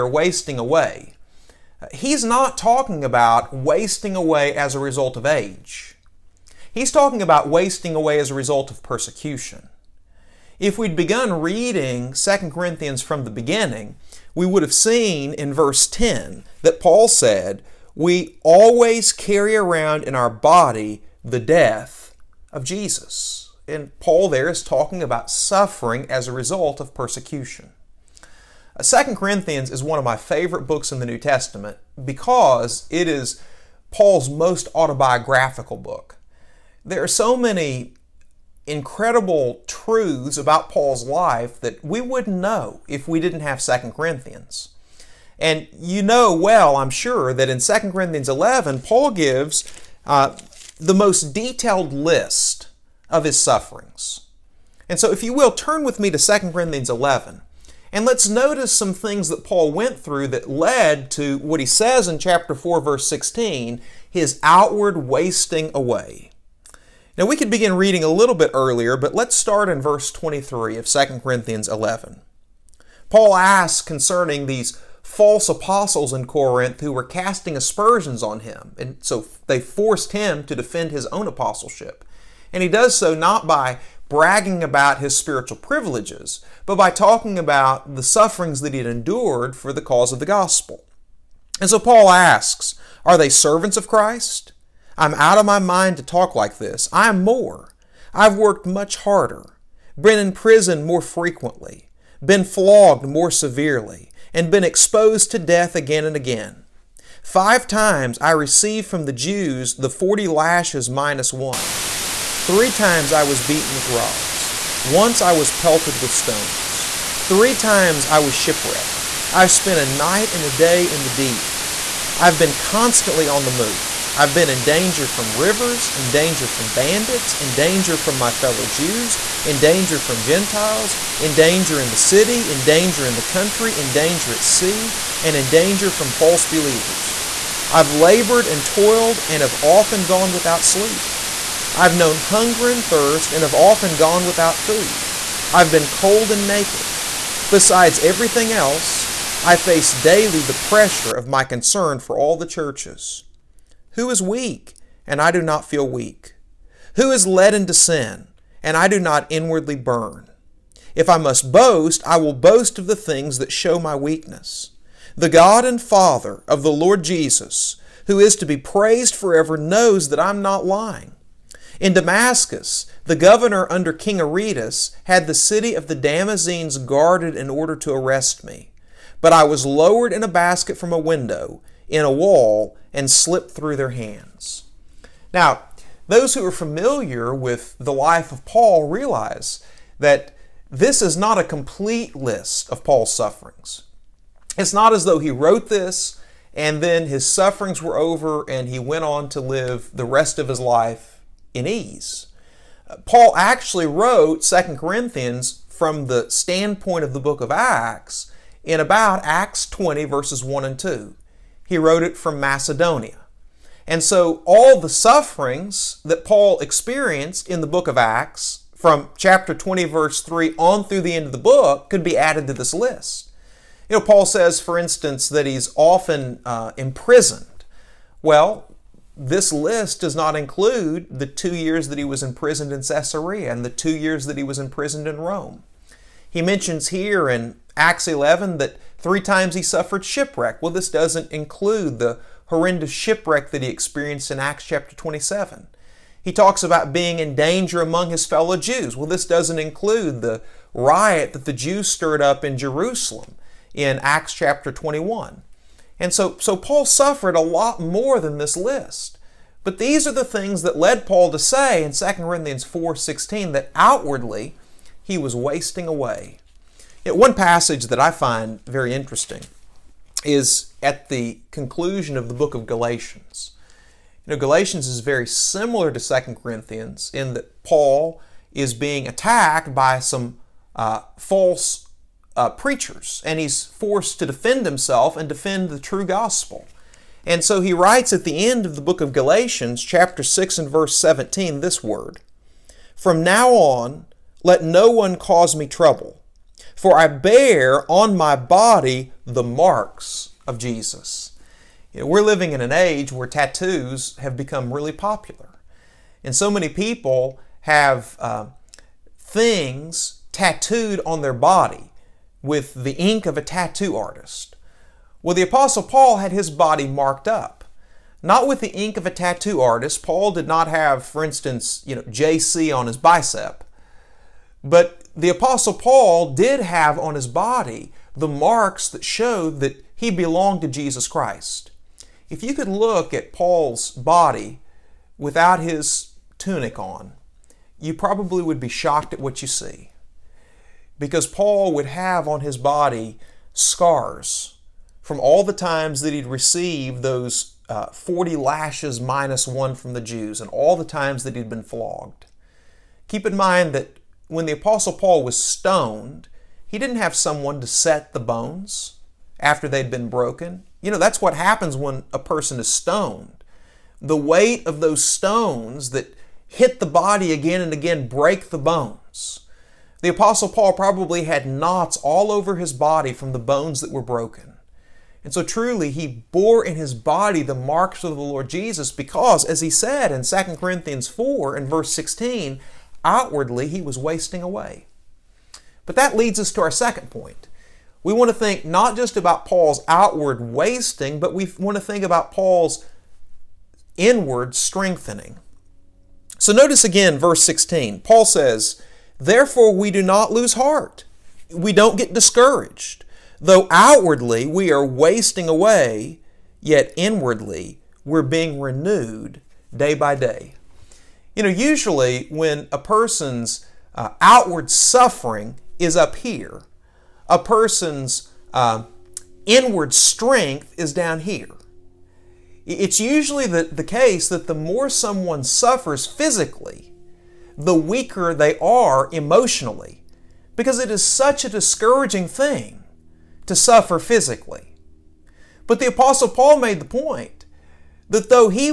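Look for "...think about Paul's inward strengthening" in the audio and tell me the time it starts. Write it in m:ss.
6:31.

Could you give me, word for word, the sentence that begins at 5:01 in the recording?
You know, we're living in an age where tattoos have become really popular.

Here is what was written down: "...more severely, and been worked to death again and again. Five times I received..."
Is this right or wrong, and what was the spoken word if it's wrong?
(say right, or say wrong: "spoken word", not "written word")
wrong: "exposed", not "worked".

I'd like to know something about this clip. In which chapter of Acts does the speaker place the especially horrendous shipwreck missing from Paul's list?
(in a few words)
Chapter 27.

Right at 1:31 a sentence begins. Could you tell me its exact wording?
And so Paul asks, Are they servants of Christ?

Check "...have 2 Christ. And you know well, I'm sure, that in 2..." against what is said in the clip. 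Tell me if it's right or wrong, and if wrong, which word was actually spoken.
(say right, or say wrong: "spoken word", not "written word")
wrong: "Corinthians", not "Christ".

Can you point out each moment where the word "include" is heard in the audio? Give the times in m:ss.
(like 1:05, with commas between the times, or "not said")
3:50, 4:01, 4:09.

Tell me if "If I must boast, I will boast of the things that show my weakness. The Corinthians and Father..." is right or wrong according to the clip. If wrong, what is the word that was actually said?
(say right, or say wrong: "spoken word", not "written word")
wrong: "God", not "Corinthians".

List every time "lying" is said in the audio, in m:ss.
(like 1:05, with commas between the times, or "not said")
2:50.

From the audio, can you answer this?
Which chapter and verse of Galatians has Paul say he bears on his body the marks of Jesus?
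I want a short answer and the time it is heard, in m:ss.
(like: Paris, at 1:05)
Chapter 6, verse 17, at 4:49.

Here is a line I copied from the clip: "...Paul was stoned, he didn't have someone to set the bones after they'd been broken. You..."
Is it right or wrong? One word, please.
right.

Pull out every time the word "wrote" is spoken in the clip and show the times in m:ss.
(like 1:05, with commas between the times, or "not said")
3:15, 3:23, 3:31.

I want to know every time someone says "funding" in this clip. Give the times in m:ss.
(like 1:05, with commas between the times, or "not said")
not said.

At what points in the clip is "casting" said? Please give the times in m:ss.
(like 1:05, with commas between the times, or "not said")
1:17.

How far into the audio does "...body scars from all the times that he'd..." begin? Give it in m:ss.
5:42.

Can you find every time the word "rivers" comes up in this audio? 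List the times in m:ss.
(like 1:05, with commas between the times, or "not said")
2:05.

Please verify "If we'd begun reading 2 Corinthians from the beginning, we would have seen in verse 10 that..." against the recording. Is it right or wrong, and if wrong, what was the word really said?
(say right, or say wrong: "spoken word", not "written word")
right.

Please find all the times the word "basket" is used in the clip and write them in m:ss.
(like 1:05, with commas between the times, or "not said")
3:00.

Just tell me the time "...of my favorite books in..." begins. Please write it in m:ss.
0:29.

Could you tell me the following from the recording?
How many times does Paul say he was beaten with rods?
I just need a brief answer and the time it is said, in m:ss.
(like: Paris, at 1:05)
3, at 1:52.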